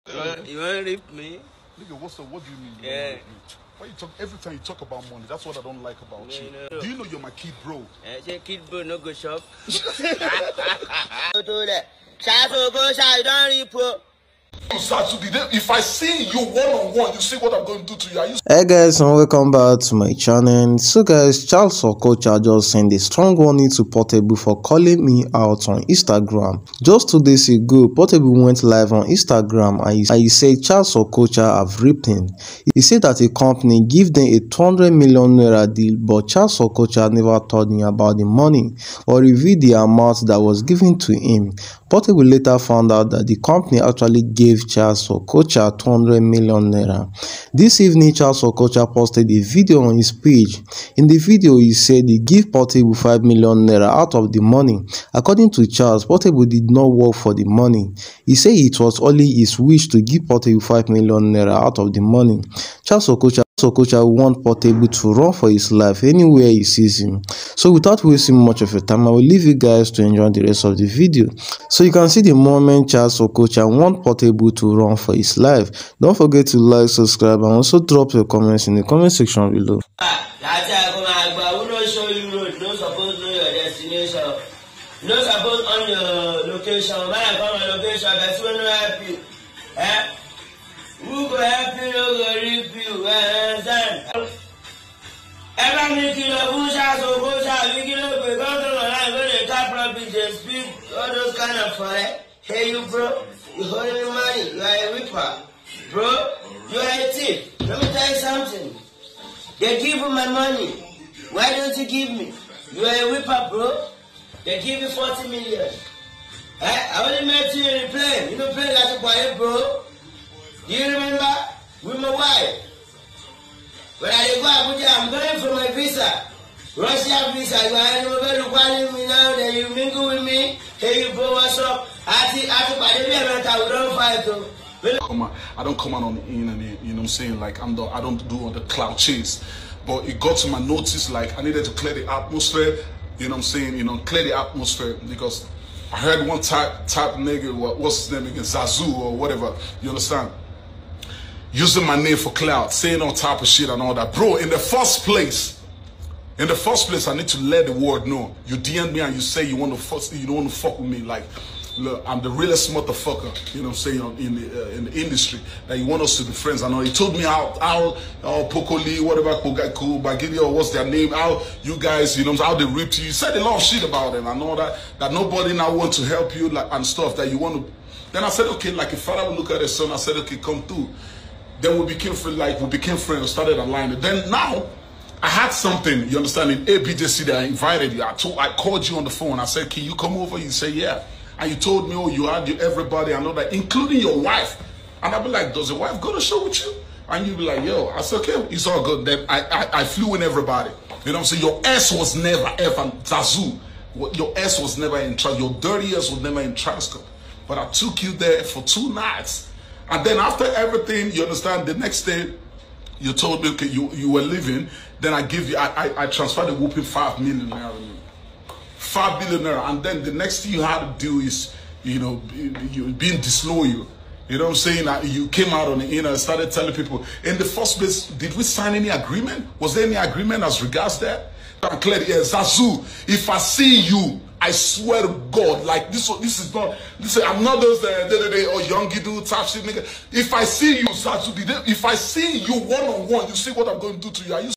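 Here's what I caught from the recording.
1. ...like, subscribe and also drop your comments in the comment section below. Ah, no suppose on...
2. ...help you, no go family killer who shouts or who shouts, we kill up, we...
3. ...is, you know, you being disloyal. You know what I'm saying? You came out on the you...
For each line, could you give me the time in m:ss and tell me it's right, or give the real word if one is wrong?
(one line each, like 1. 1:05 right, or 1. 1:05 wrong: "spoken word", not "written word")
1. 1:16 right
2. 1:31 right
3. 3:41 right.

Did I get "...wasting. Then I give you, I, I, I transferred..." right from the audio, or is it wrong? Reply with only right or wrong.
wrong.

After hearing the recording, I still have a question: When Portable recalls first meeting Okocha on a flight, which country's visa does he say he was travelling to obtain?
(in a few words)
Russia.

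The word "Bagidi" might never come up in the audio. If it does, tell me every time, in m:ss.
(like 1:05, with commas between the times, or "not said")
2:50.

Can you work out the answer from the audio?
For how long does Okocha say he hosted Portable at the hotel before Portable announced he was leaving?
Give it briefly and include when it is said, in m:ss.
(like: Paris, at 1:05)
Two nights, at 3:28.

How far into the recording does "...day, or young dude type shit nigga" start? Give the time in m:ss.
3:58.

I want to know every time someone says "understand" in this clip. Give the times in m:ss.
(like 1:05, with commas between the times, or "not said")
2:29, 3:06, 3:31.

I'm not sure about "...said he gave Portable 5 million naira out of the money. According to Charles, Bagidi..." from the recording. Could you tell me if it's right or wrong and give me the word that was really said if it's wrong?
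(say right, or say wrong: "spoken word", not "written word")
wrong: "Portable", not "Bagidi".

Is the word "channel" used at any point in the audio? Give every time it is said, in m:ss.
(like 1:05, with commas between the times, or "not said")
0:20.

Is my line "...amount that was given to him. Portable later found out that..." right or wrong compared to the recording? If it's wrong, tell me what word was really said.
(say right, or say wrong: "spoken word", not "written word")
right.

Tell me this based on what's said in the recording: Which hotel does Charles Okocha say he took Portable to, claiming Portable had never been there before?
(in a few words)
Transcorp.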